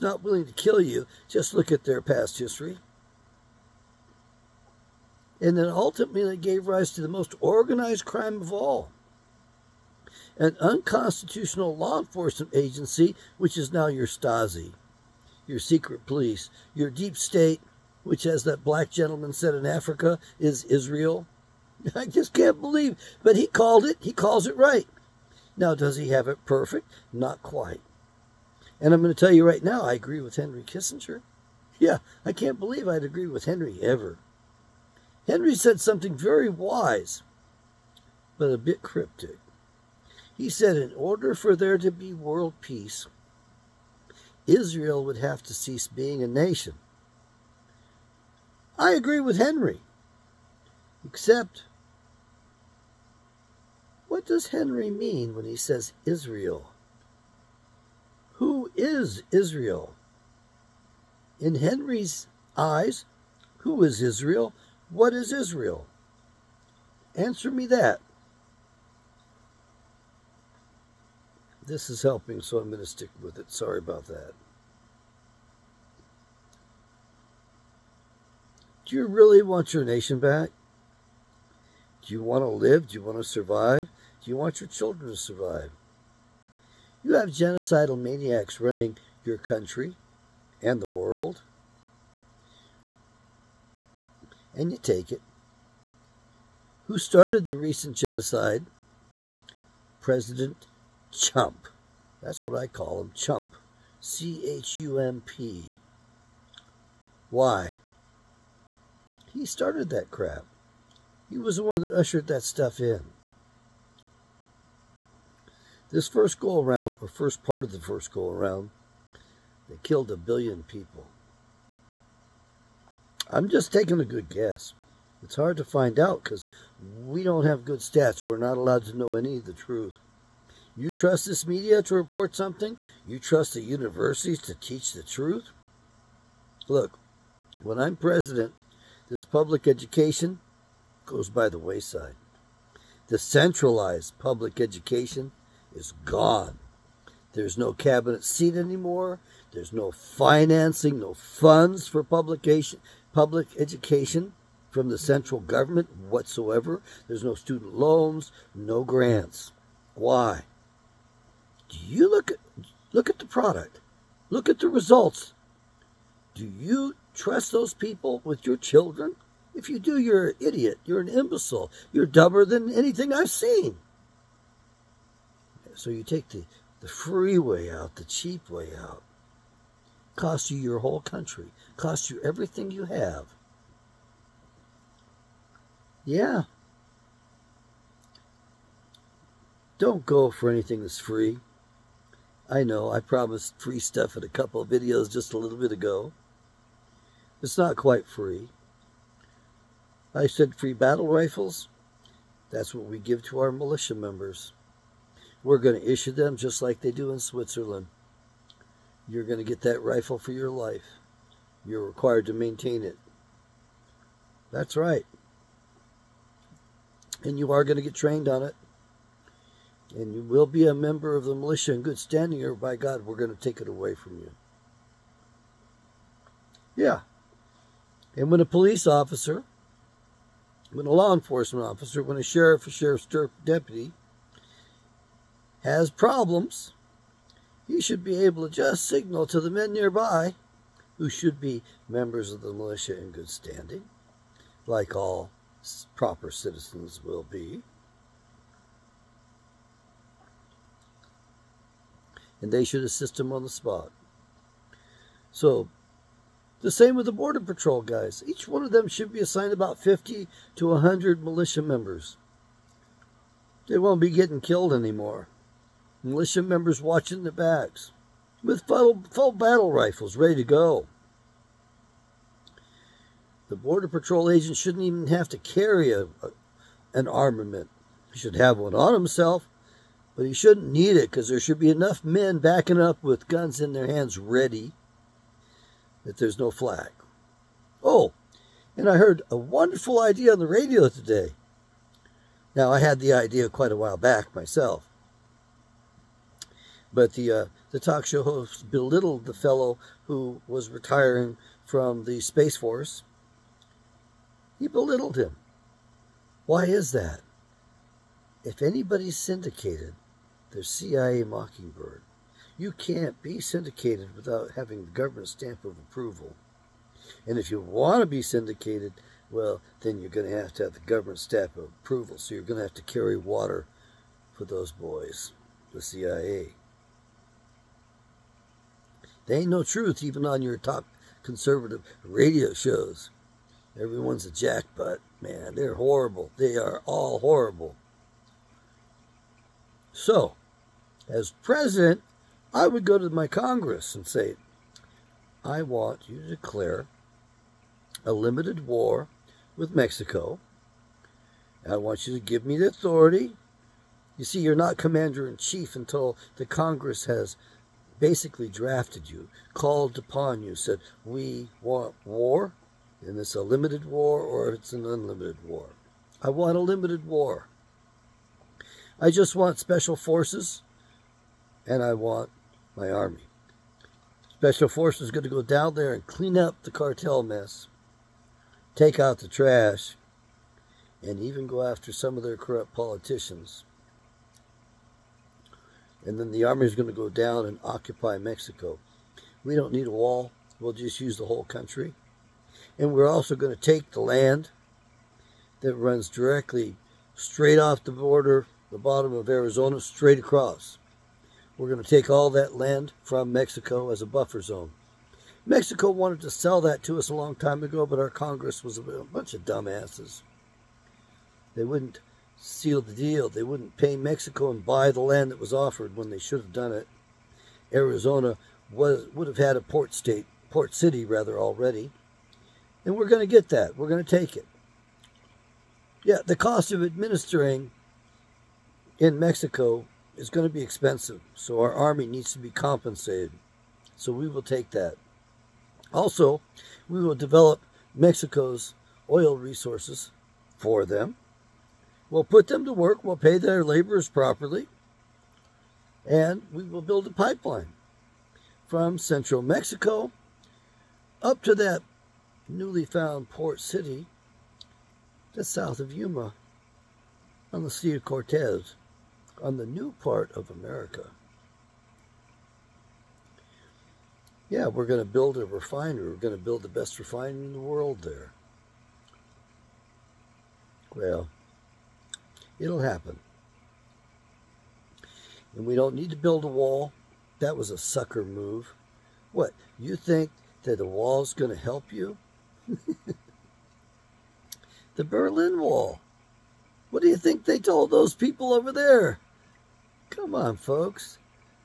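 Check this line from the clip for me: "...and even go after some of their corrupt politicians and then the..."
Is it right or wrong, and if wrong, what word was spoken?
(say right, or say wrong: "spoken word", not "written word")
right.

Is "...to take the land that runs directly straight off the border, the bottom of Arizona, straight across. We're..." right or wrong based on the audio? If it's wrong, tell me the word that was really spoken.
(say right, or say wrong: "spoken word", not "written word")
right.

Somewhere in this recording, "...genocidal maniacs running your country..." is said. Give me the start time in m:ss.
1:27.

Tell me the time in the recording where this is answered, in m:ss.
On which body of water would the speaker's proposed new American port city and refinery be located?
7:37.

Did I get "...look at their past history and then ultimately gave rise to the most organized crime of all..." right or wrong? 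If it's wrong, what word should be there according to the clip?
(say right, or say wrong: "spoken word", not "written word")
right.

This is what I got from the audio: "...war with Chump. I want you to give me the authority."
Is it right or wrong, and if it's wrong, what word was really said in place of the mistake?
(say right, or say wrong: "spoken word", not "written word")
wrong: "Mexico", not "Chump".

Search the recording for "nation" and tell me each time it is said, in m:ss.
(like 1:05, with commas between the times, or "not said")
0:46, 1:19.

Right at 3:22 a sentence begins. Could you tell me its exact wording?
That's what we give to our militia members.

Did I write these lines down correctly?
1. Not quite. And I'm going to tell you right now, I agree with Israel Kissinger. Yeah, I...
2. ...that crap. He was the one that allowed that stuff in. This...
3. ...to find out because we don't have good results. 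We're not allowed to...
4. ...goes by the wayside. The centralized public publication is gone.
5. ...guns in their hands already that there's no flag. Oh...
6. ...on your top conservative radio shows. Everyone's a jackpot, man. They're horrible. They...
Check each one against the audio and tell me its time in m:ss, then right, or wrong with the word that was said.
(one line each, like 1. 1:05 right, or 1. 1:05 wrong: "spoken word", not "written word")
1. 0:27 wrong: "Henry", not "Israel"
2. 1:49 wrong: "ushered", not "allowed"
3. 2:05 wrong: "stats", not "results"
4. 2:21 wrong: "education", not "publication"
5. 4:43 wrong: "ready", not "already"
6. 5:30 right.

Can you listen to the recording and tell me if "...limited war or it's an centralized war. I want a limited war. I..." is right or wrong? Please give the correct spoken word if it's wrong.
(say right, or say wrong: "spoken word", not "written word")
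wrong: "unlimited", not "centralized".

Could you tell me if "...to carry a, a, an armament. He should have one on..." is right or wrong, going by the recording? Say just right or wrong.
right.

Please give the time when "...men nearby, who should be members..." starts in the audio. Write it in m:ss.
3:59.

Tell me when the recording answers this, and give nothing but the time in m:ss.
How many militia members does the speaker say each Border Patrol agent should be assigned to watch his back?
4:19.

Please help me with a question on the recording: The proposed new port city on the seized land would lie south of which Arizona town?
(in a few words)
Yuma.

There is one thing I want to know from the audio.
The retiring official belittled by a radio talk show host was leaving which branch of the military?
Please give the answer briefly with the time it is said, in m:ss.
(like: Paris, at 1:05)
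Space Force, at 5:02.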